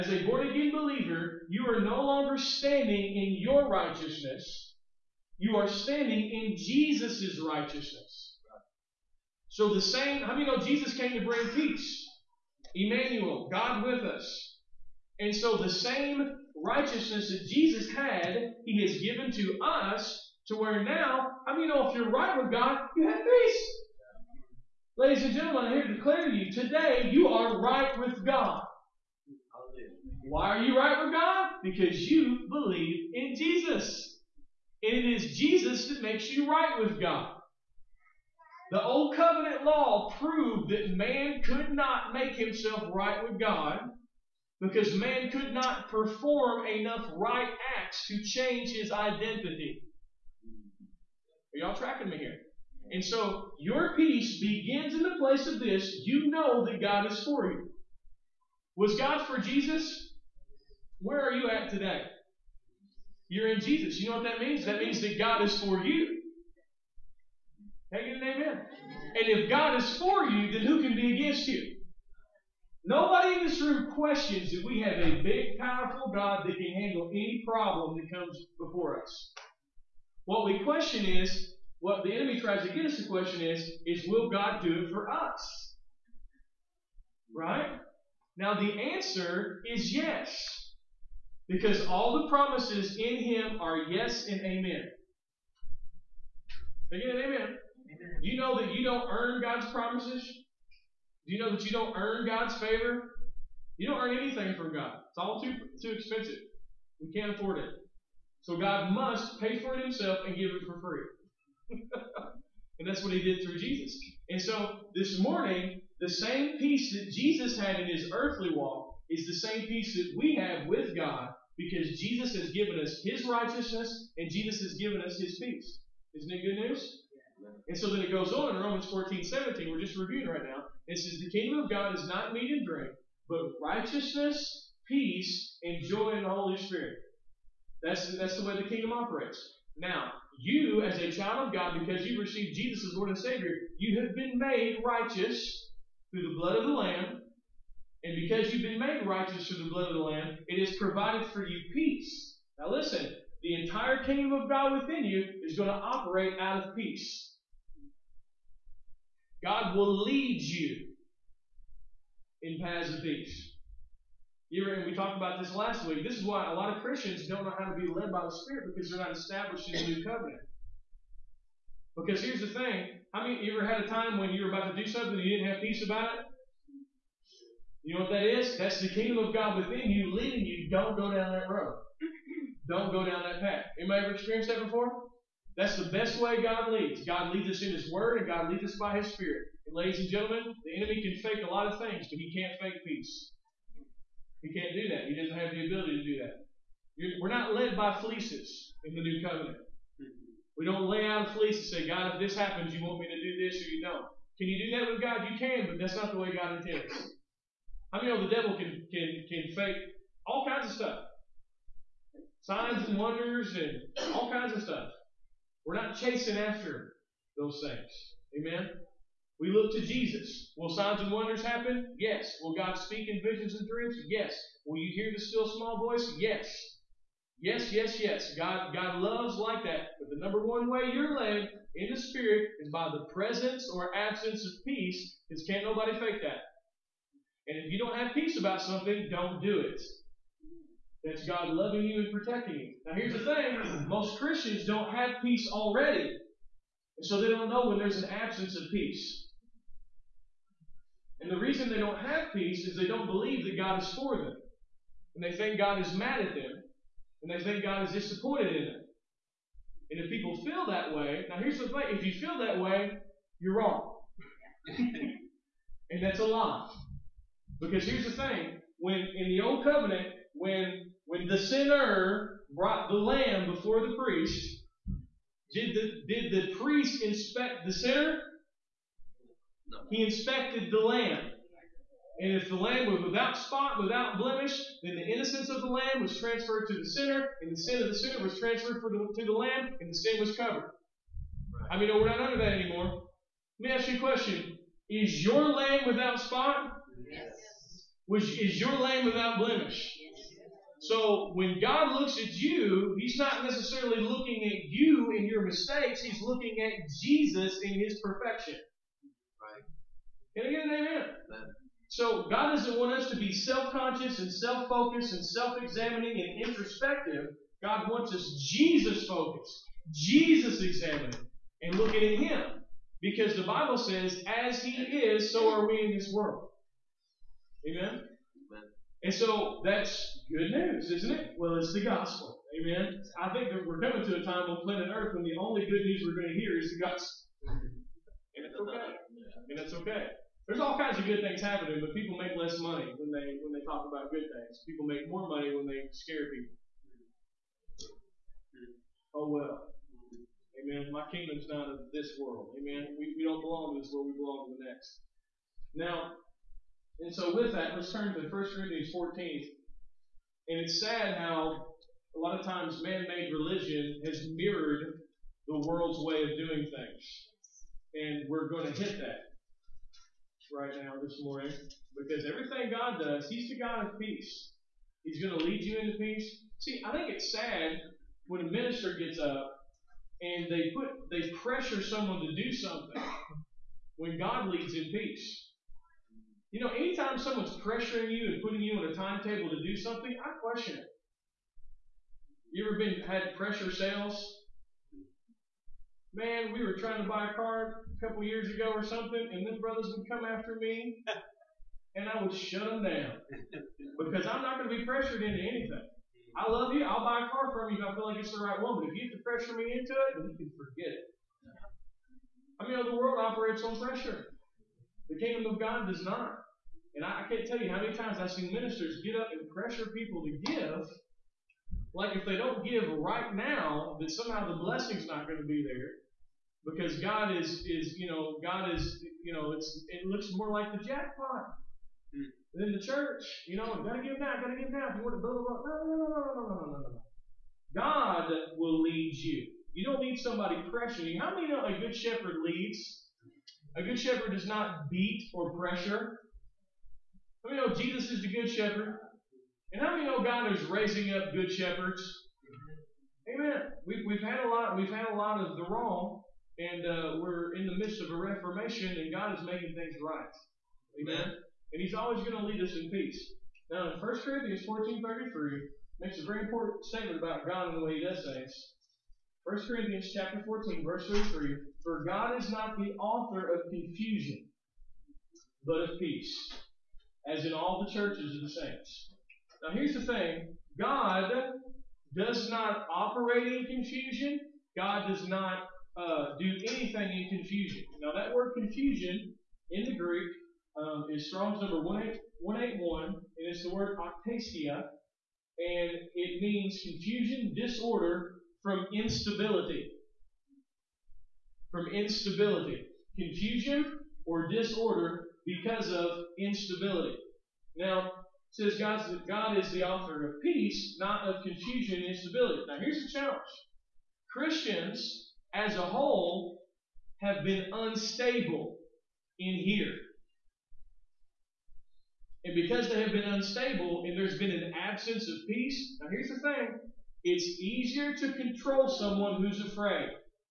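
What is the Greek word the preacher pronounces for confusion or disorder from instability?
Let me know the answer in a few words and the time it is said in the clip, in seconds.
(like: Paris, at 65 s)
Octasia, at 493 s.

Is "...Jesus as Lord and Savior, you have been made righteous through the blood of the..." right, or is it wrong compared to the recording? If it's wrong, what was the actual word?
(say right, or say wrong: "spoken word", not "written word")
right.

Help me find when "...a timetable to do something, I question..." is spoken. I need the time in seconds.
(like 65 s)
388 s.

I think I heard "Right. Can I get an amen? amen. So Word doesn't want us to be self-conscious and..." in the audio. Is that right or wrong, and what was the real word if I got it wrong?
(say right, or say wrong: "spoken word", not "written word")
wrong: "God", not "Word".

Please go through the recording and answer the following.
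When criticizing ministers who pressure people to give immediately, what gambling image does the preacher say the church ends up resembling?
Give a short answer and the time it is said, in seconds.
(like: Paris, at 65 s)
The jackpot, at 430 s.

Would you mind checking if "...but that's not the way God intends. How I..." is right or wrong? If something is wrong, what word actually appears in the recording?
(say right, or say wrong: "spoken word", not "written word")
right.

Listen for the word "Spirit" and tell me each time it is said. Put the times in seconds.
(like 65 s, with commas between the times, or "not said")
136 s, 168 s, 189 s, 231 s.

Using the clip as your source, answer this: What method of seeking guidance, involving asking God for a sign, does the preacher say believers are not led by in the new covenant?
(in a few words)
Fleeces.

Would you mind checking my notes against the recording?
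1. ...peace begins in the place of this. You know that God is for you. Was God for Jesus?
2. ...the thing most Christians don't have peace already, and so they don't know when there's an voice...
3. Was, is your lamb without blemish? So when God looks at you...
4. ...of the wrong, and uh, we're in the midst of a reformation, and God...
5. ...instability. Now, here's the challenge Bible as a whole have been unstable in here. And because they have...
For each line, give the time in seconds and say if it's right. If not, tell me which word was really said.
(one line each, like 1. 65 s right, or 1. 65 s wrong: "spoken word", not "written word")
1. 53 s right
2. 243 s wrong: "absence", not "voice"
3. 298 s right
4. 455 s right
5. 512 s wrong: "Christians", not "Bible".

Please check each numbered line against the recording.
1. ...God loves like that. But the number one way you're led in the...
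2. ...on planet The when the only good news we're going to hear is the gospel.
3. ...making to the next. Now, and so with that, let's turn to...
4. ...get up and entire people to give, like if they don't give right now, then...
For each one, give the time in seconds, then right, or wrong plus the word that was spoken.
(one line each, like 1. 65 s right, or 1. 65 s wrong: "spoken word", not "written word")
1. 228 s right
2. 334 s wrong: "Earth", not "The"
3. 354 s wrong: "belong", not "making"
4. 419 s wrong: "pressure", not "entire".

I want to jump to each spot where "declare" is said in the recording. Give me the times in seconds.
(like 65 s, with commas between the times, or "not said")
25 s.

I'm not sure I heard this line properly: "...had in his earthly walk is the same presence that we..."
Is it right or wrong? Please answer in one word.
wrong.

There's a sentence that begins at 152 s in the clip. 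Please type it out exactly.
Now, listen, the entire kingdom of God within you is going to operate out of peace.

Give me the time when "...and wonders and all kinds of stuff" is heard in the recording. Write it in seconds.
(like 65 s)
212 s.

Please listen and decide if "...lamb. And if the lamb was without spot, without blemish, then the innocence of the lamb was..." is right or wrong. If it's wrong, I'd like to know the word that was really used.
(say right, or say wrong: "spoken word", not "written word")
right.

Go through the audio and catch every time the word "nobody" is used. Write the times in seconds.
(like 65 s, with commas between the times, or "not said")
72 s, 235 s.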